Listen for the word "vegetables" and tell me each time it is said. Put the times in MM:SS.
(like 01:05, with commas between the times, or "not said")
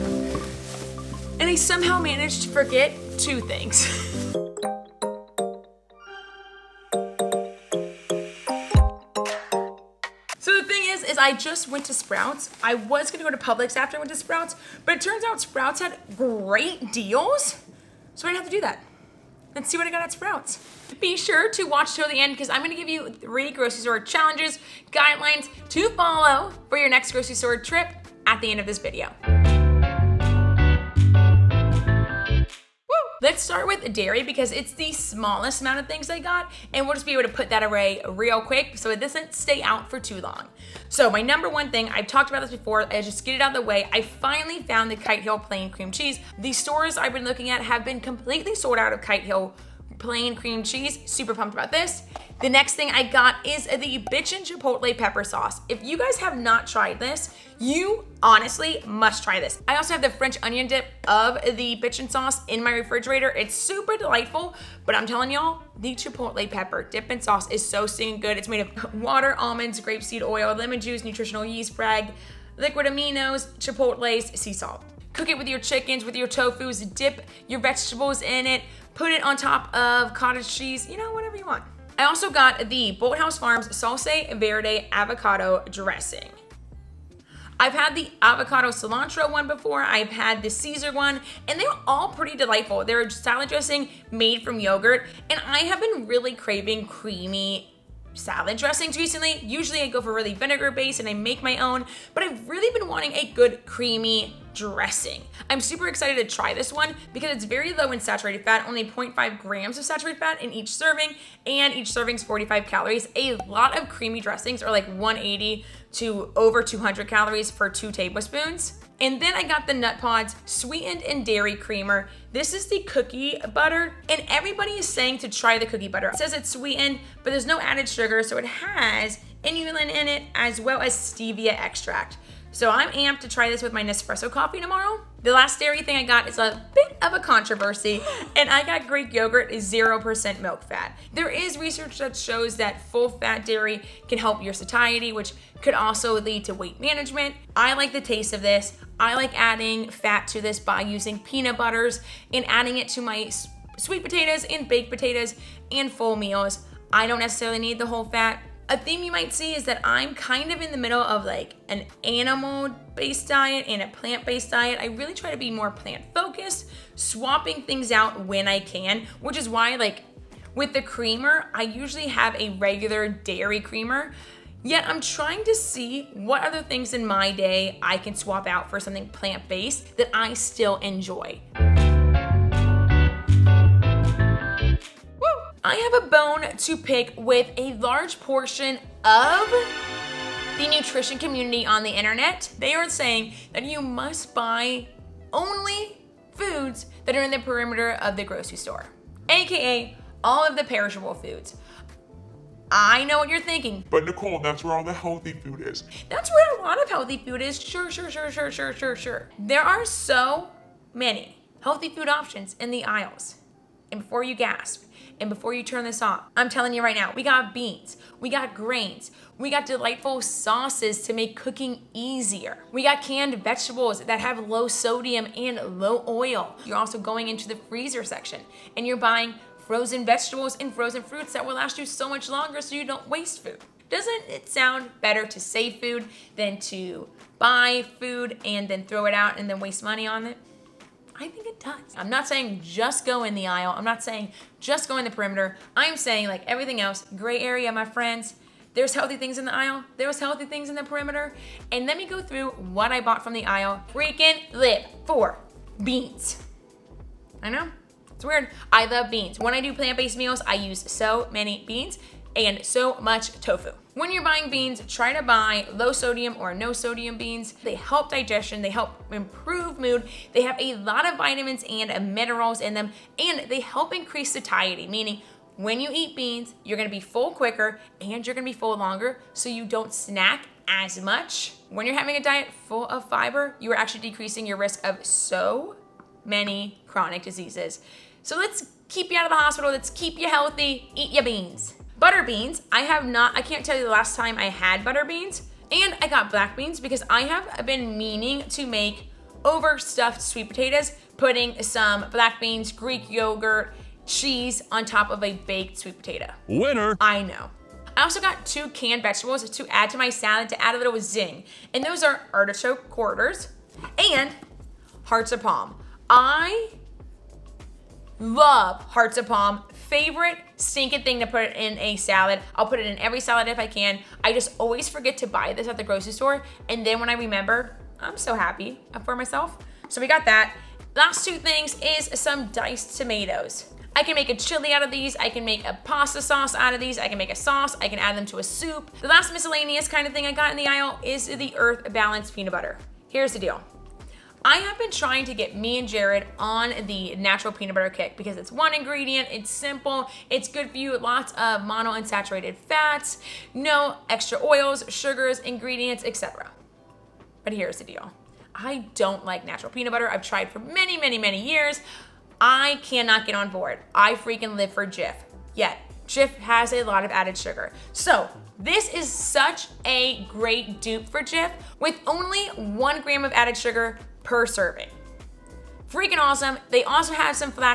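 01:17, 03:43, 03:50, 05:09.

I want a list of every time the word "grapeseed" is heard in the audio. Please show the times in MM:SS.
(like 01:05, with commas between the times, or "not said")
01:09.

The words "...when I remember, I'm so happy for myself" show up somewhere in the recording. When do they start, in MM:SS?
05:26.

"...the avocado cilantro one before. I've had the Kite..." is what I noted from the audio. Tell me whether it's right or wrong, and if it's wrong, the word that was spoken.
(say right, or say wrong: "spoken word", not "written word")
wrong: "Caesar", not "Kite".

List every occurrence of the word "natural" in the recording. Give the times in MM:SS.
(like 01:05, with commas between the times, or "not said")
05:47, 05:59.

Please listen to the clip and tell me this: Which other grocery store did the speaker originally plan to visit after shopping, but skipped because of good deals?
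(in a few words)
Publix.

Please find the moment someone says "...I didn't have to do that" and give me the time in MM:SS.
00:18.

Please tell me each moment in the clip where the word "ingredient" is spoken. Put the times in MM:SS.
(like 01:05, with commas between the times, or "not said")
05:48, 05:55.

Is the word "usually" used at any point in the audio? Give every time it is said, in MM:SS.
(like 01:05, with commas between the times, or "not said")
01:39, 02:51.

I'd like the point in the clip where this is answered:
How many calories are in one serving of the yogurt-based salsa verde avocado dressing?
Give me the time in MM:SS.
01:52.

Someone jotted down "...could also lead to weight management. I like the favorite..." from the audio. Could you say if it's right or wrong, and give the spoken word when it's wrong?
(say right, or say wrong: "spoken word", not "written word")
wrong: "taste", not "favorite".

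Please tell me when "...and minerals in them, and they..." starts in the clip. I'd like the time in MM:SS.
04:31.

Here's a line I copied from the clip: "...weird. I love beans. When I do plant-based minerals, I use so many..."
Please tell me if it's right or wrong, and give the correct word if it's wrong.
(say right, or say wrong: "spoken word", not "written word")
wrong: "meals", not "minerals".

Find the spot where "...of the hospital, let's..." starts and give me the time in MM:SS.
04:49.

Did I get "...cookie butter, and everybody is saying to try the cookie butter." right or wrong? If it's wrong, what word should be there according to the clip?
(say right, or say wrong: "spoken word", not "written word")
right.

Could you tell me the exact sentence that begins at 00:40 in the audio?
So my number one thing, I've talked about this before, I just get it out of the way.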